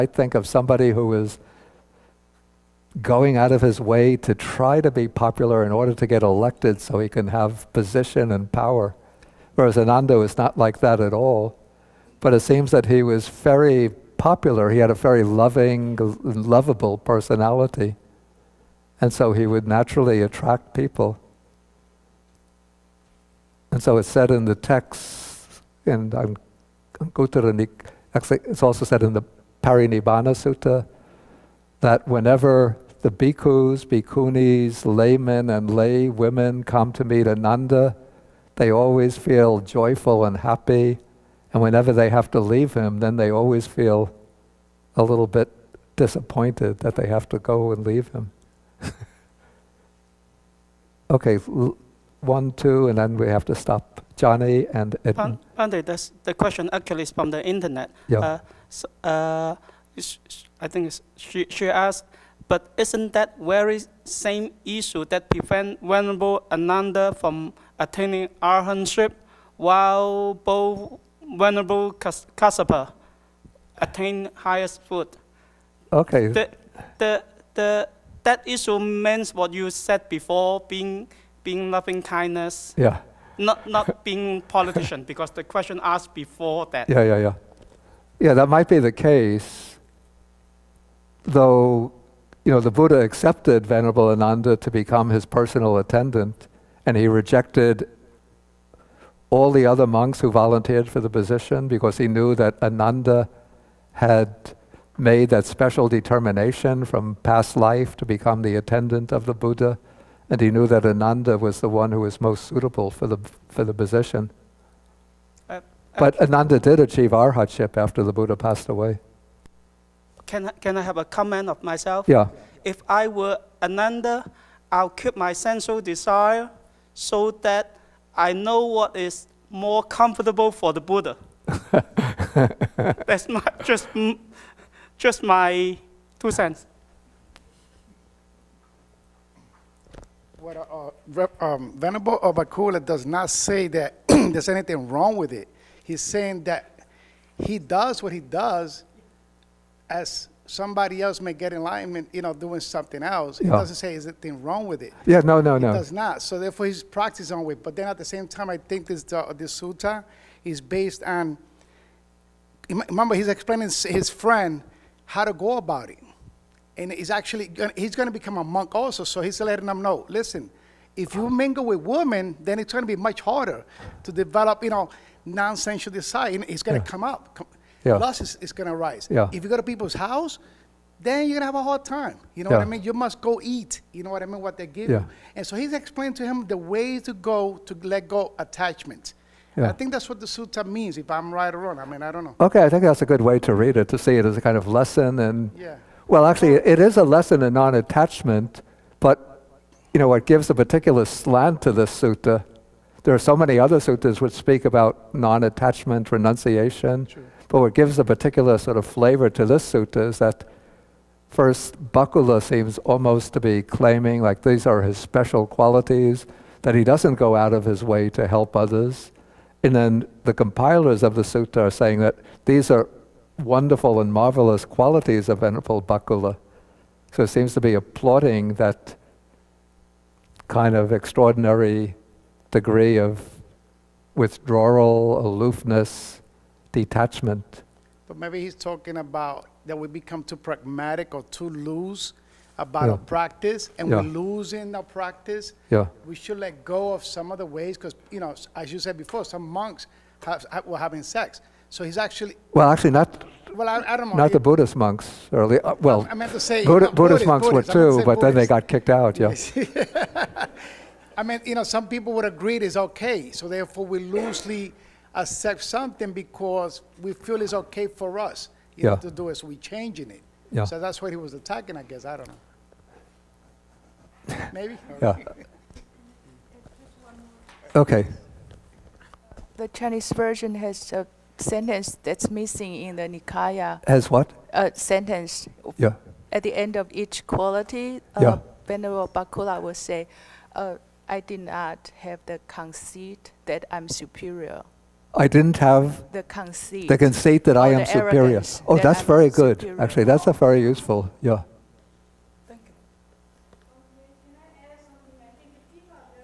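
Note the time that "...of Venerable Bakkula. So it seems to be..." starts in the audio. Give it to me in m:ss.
3:45.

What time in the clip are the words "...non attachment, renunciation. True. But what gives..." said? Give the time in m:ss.
3:25.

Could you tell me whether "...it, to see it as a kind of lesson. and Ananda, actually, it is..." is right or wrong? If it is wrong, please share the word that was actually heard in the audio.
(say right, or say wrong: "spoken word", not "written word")
wrong: "Well", not "Ananda".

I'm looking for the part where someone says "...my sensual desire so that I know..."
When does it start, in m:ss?
2:05.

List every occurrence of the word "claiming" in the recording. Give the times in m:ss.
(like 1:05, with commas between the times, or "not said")
3:33.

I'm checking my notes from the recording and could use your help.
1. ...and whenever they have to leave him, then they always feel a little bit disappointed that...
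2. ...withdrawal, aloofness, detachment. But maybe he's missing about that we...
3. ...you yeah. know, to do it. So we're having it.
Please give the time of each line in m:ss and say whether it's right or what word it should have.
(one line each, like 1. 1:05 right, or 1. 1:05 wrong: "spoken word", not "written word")
1. 0:41 right
2. 3:54 wrong: "talking", not "missing"
3. 4:28 wrong: "changing", not "having".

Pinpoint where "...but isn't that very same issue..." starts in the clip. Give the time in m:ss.
1:02.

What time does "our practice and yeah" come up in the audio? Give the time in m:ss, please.
4:02.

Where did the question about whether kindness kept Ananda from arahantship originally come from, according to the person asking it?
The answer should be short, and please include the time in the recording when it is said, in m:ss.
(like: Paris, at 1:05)
The internet, at 0:57.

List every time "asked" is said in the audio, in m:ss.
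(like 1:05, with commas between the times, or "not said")
1:01, 1:25.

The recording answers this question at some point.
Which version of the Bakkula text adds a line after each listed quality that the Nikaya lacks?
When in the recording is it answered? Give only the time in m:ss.
4:39.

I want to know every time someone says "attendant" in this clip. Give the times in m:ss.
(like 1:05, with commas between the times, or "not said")
1:35, 1:48.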